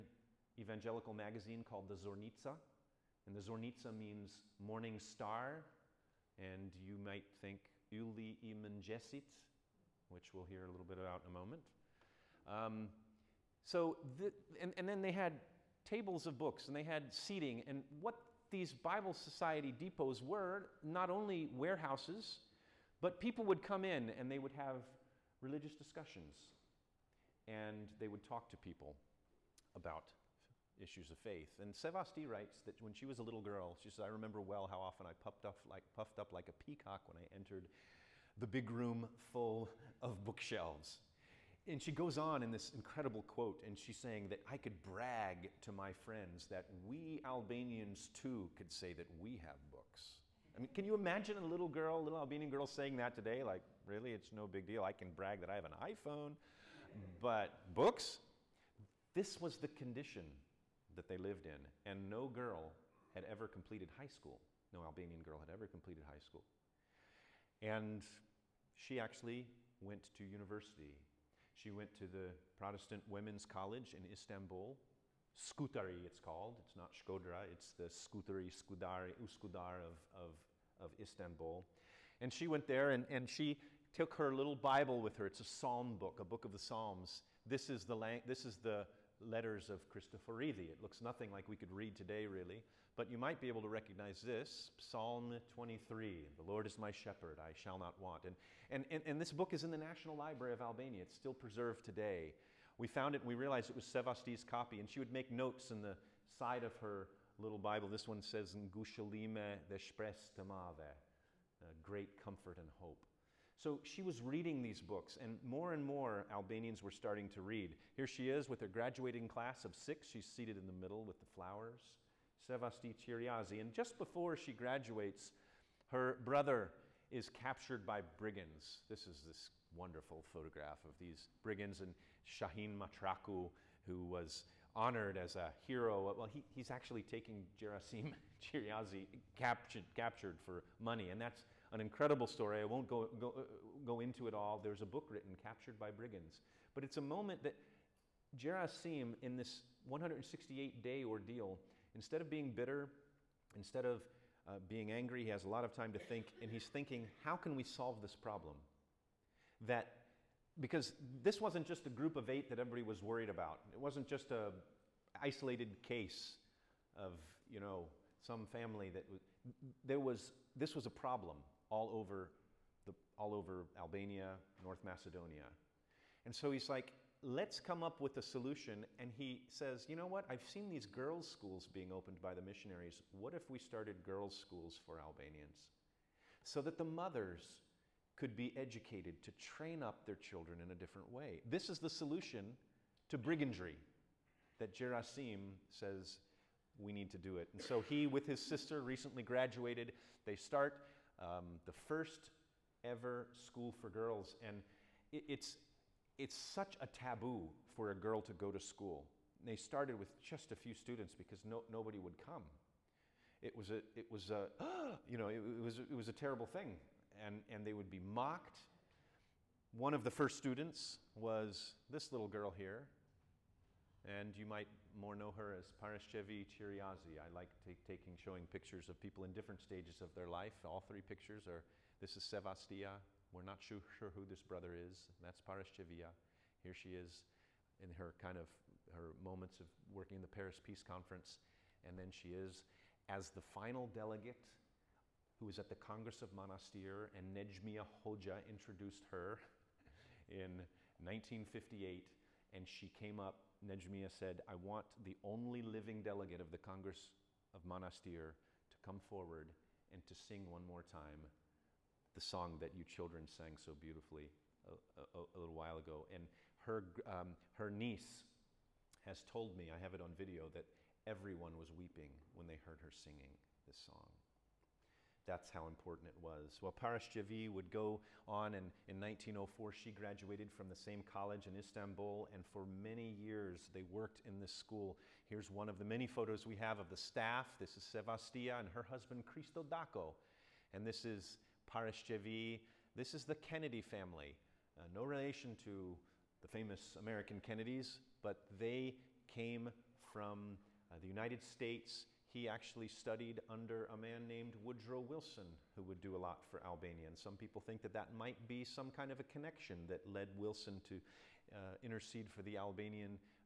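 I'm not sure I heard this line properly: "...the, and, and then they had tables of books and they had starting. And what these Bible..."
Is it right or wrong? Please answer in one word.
wrong.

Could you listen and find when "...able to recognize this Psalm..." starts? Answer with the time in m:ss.
1:33.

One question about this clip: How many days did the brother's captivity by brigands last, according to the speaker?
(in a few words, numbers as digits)
168.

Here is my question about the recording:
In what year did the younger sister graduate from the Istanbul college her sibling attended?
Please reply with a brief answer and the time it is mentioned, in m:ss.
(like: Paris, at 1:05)
1904, at 4:39.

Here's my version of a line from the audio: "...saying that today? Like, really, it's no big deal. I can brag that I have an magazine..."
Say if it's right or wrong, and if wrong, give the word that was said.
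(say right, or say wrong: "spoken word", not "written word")
wrong: "iPhone", not "magazine".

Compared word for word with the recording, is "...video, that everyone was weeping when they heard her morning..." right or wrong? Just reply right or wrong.
wrong.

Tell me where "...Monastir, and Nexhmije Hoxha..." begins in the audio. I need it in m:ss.
4:06.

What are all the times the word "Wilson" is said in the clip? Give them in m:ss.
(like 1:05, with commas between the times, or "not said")
5:04, 5:10.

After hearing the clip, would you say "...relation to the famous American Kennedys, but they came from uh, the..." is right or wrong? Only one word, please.
right.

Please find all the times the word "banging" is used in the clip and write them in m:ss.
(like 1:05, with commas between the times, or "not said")
not said.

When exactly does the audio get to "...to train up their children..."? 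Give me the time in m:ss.
3:09.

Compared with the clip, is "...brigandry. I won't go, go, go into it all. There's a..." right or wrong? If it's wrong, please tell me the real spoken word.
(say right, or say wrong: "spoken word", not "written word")
wrong: "story", not "brigandry".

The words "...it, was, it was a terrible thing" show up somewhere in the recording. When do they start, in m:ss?
3:35.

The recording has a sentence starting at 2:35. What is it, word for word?
He has a lot of time to think, and he's thinking, how can we solve this problem?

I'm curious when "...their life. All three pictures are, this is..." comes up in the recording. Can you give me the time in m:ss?
3:50.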